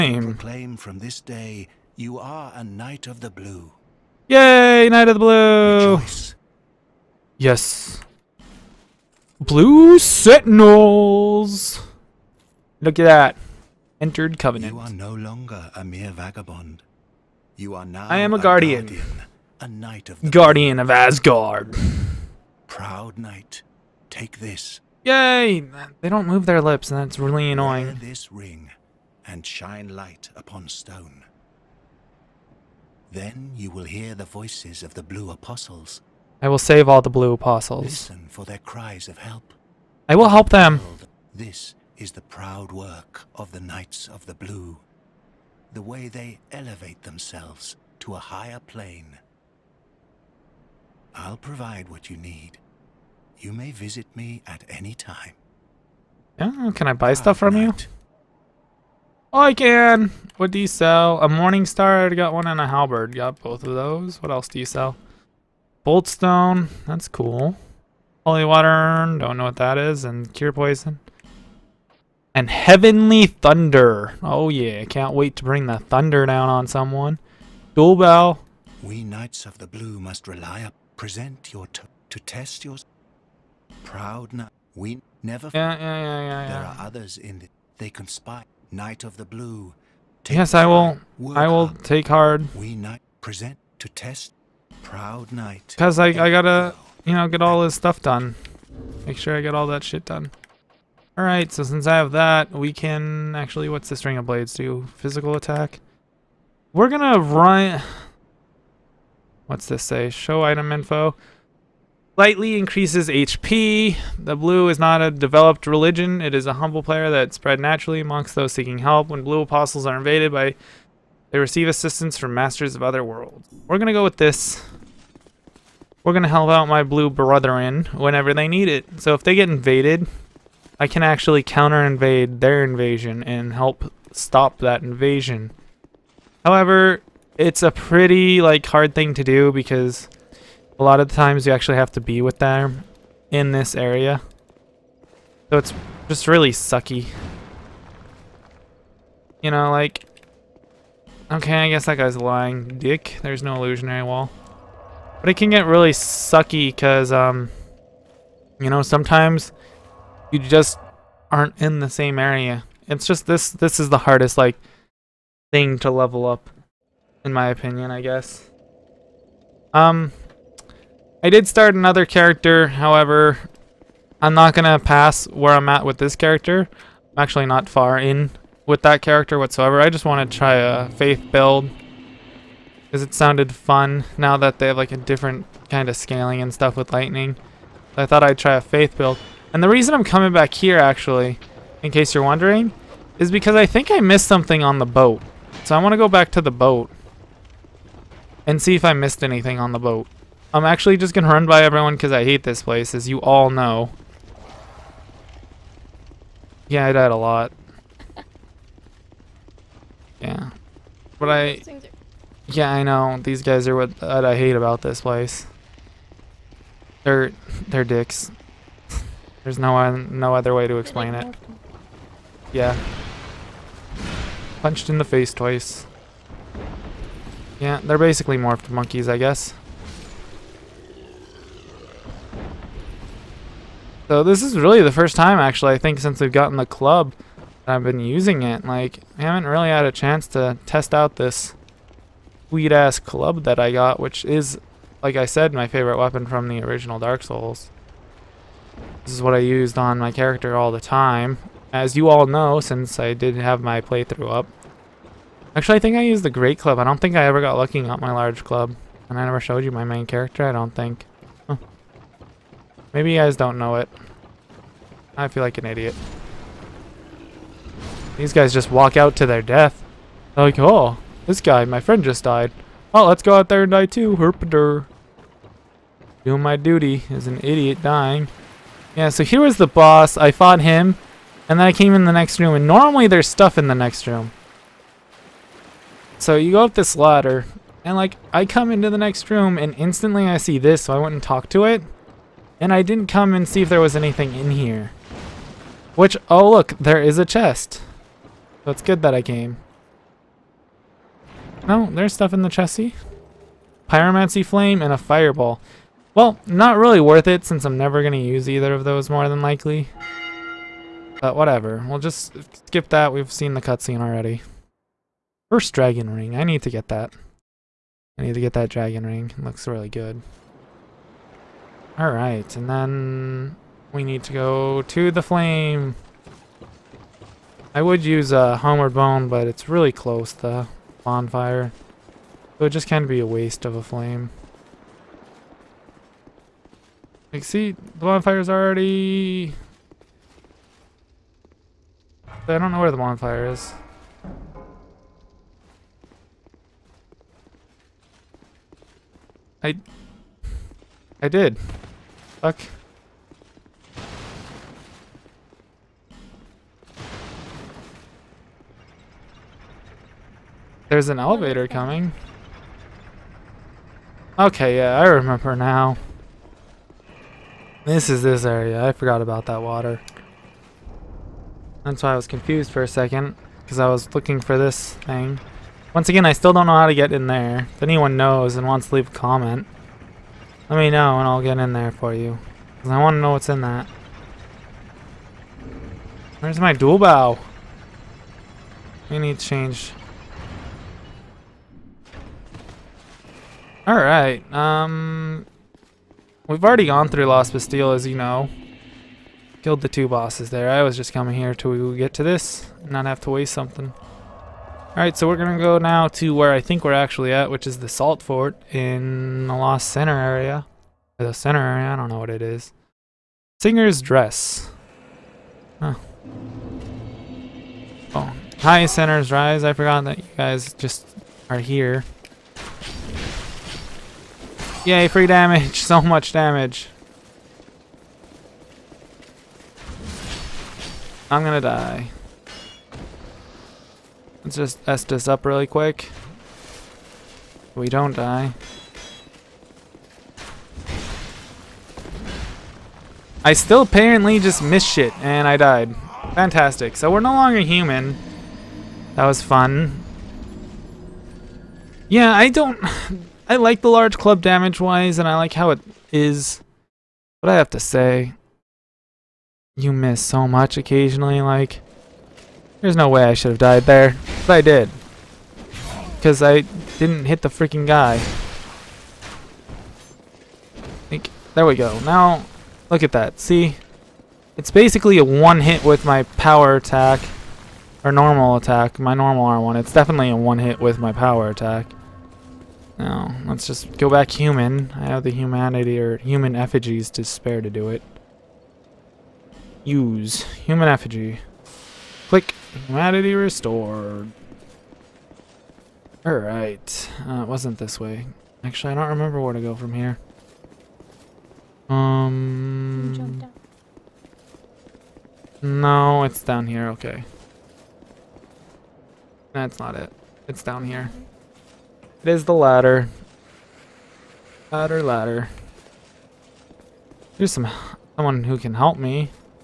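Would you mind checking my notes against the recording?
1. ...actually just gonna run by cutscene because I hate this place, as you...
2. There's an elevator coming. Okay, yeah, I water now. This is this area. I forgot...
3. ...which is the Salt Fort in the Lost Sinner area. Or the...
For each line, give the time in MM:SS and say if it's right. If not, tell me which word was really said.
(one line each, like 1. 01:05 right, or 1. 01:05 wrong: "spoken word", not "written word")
1. 03:20 wrong: "everyone", not "cutscene"
2. 06:00 wrong: "remember", not "water"
3. 06:47 right.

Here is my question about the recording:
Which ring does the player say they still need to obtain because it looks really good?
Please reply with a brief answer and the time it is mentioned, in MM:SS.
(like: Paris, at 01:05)
First dragon ring, at 05:15.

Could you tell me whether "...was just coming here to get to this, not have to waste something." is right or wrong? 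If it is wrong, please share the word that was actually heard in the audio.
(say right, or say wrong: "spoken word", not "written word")
right.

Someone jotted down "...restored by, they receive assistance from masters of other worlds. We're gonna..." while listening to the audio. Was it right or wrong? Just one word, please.
wrong.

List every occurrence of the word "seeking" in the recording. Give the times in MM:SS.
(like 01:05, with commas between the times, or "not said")
01:58.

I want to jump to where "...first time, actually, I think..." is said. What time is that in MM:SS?
03:54.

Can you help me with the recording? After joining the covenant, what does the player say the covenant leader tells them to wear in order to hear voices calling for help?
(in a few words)
This ring.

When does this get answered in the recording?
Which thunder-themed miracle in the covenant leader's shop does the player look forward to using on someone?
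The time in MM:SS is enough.
01:12.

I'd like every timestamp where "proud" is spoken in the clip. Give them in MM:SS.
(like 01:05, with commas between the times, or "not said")
00:22, 00:42, 01:23, 01:34.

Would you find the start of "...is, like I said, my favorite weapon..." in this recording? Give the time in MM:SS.
04:04.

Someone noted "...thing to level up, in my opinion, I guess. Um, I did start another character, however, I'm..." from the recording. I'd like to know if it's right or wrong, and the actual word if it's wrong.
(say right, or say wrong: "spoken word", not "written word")
right.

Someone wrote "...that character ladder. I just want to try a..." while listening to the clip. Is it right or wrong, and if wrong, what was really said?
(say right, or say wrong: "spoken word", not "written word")
wrong: "whatsoever", not "ladder".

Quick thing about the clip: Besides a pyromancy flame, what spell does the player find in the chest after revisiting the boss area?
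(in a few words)
Fireball.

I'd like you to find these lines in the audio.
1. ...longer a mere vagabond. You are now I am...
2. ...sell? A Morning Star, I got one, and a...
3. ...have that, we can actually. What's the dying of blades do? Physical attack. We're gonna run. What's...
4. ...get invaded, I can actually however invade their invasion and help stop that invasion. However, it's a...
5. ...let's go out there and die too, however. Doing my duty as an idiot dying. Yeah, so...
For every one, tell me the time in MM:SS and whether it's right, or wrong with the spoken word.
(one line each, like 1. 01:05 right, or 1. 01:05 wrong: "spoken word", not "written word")
1. 00:15 right
2. 01:00 right
3. 01:41 wrong: "string", not "dying"
4. 02:09 wrong: "counter", not "however"
5. 04:33 wrong: "herpader", not "however".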